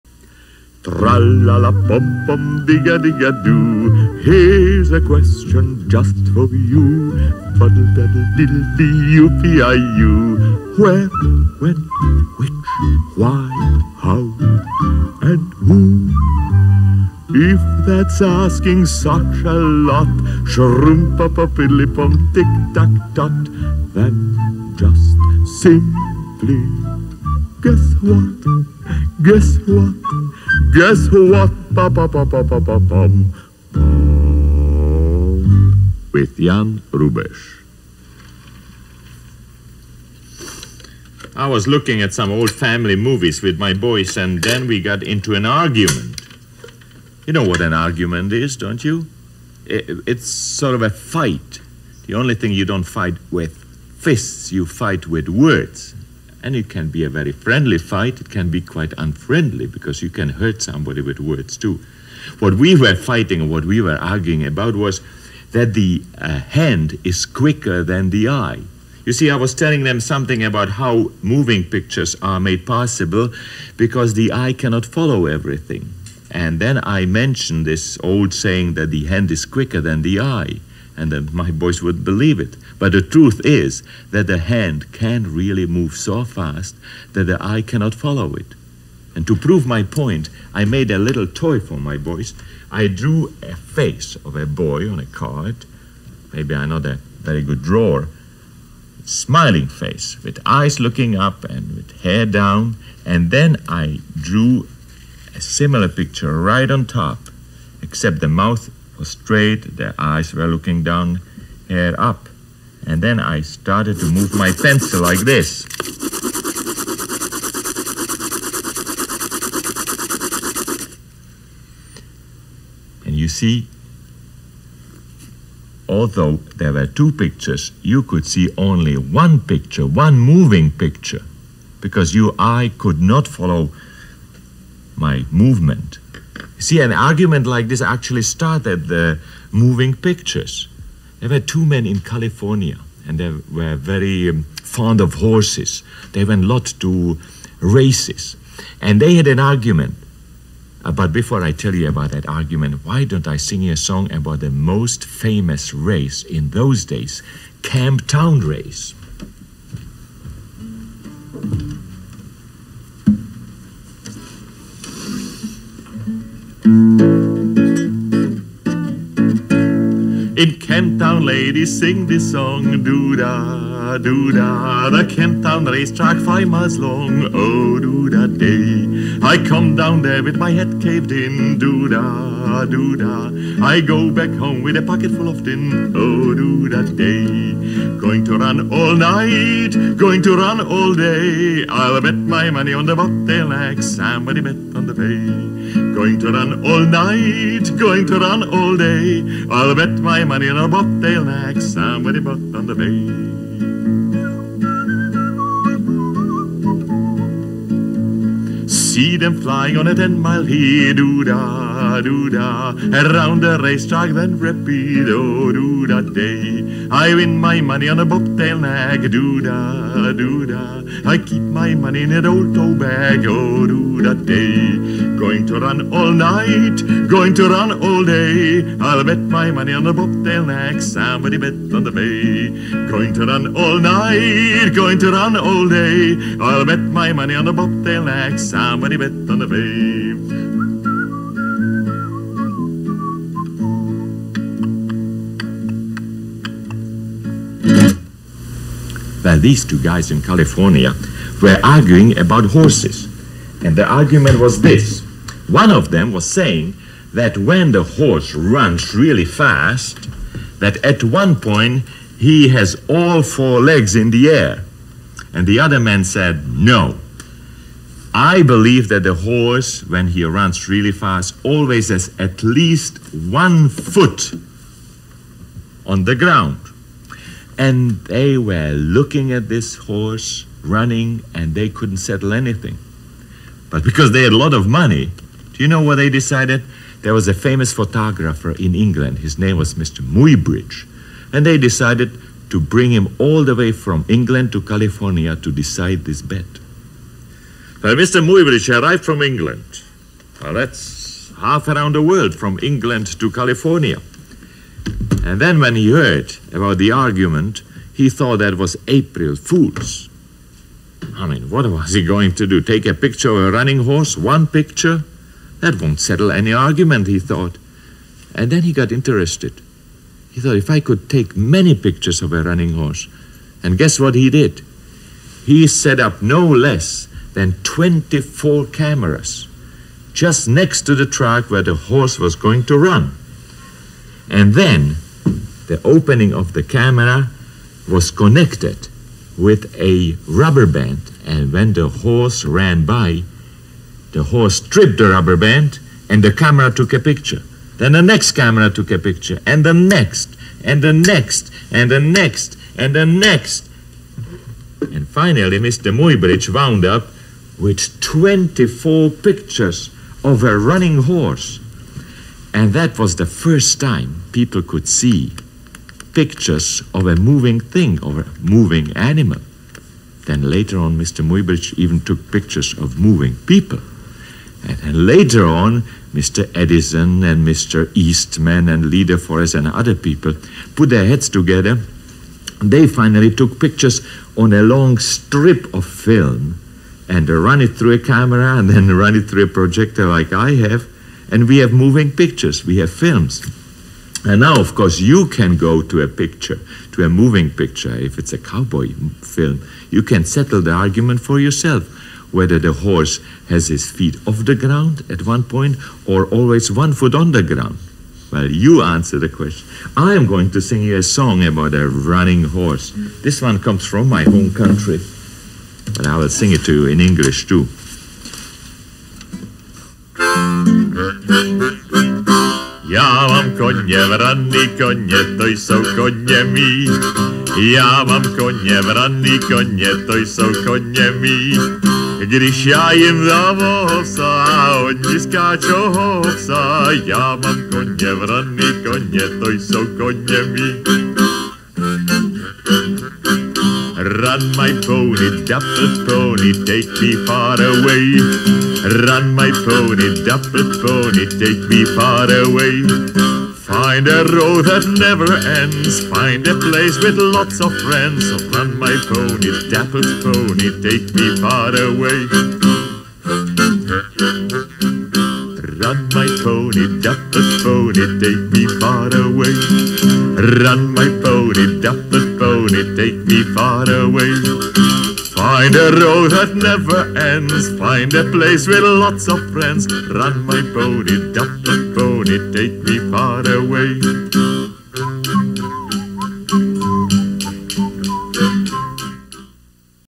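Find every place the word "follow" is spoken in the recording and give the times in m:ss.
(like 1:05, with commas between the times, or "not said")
1:14, 1:27, 2:13.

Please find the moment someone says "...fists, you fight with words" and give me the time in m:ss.
0:53.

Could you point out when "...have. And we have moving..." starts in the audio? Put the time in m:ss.
6:30.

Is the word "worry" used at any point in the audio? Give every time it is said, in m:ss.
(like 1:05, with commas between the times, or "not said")
not said.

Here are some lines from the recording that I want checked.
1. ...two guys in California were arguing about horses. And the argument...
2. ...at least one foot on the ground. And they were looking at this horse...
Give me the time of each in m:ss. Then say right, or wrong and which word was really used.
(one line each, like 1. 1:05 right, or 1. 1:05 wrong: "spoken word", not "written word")
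1. 4:09 right
2. 4:32 right.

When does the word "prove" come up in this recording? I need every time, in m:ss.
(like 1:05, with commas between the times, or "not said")
1:29.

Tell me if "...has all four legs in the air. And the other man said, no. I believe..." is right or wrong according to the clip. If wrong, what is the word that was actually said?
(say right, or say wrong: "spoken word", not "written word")
right.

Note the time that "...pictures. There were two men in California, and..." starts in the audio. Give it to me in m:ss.
2:19.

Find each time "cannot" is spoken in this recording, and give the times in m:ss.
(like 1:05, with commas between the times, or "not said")
1:14, 1:27.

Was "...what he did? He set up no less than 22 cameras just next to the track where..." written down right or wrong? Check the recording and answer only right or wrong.
wrong.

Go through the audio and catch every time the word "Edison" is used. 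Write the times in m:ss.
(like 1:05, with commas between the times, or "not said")
6:16.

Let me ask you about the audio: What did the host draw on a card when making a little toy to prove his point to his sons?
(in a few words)
A face of a boy.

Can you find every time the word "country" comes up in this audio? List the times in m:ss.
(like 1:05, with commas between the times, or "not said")
6:54.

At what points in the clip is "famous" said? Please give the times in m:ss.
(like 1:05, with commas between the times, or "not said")
2:35, 4:47.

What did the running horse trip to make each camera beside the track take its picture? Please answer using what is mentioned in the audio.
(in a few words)
A rubber band.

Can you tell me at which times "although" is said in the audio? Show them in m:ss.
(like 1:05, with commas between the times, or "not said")
2:05.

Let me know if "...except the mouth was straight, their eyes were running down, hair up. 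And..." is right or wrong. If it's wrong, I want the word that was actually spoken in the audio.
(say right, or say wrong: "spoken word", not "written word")
wrong: "looking", not "running".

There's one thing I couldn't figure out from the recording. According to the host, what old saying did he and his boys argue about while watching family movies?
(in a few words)
The hand is quicker than the eye.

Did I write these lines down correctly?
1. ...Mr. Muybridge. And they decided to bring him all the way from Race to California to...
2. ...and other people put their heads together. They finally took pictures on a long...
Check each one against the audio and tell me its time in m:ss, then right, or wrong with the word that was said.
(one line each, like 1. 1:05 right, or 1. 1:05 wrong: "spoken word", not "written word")
1. 4:49 wrong: "England", not "Race"
2. 6:19 right.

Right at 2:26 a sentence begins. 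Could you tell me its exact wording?
They went a lot to races, and they had an argument.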